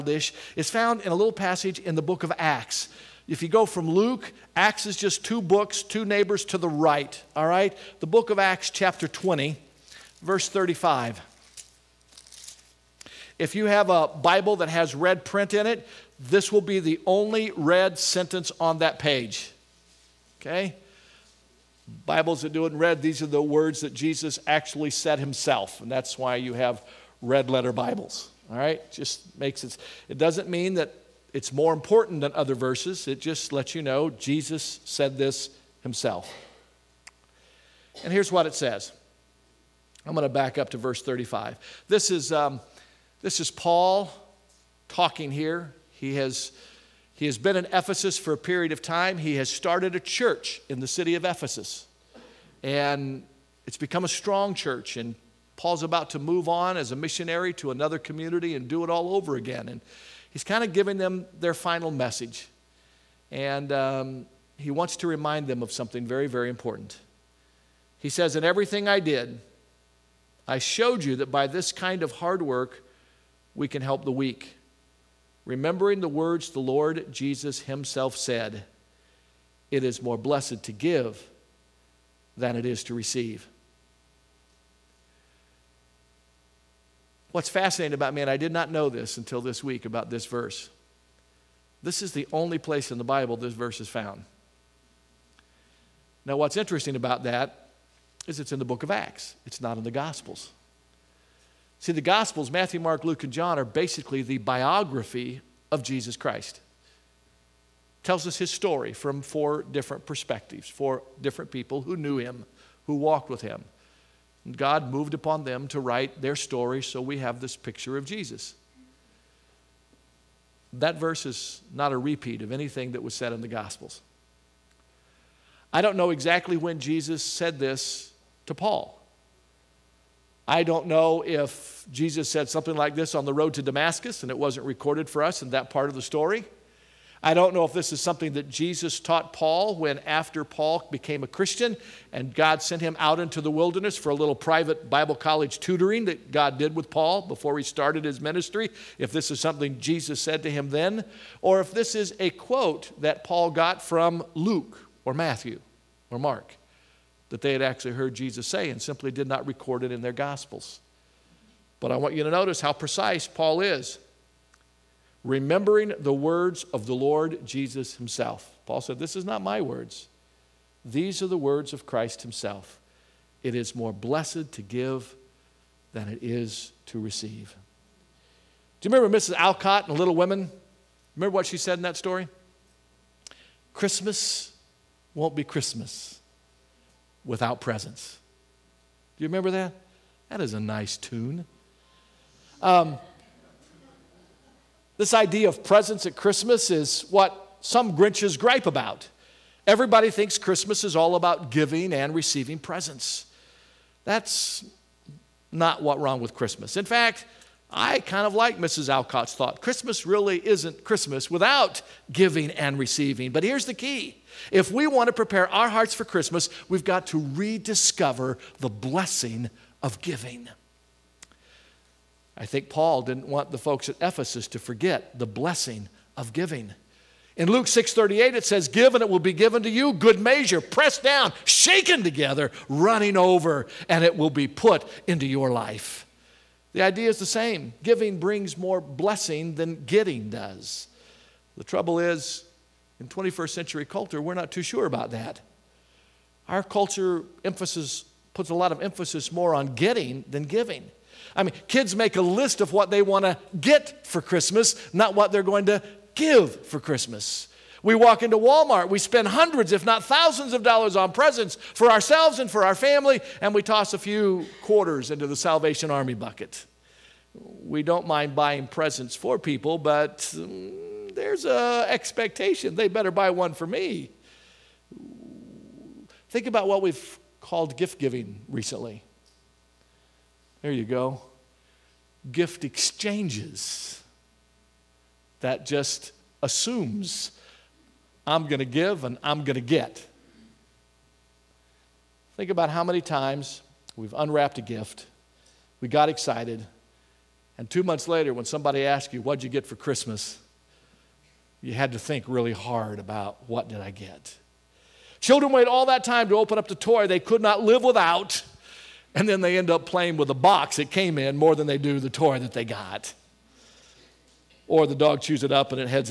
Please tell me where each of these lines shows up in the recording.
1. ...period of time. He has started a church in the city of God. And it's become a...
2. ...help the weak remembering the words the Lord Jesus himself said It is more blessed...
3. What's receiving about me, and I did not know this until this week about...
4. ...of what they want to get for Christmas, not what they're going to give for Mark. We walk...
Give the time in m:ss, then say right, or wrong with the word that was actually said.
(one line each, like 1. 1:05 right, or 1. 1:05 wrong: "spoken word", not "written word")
1. 0:48 wrong: "Ephesus", not "God"
2. 1:13 right
3. 1:27 wrong: "fascinating", not "receiving"
4. 4:12 wrong: "Christmas", not "Mark".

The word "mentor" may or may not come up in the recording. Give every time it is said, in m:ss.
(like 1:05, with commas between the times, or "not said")
not said.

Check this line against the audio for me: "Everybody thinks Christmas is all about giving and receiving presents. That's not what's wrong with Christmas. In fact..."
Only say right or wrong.
right.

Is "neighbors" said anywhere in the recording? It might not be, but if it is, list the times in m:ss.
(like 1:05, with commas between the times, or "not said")
0:06.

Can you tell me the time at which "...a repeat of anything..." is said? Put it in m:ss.
2:01.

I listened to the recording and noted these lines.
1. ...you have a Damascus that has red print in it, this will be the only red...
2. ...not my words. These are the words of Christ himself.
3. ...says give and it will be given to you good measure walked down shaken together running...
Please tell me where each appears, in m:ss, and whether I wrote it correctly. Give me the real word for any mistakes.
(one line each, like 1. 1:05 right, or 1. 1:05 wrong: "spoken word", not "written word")
1. 0:13 wrong: "Bible", not "Damascus"
2. 2:49 right
3. 3:48 wrong: "pressed", not "walked".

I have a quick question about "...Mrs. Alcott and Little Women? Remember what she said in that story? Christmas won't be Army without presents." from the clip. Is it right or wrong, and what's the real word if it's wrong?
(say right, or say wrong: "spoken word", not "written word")
wrong: "Christmas", not "Army".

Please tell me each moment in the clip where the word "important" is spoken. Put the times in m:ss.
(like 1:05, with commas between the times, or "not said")
0:31, 1:06.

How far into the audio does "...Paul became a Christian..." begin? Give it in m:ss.
2:20.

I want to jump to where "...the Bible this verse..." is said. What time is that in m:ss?
1:32.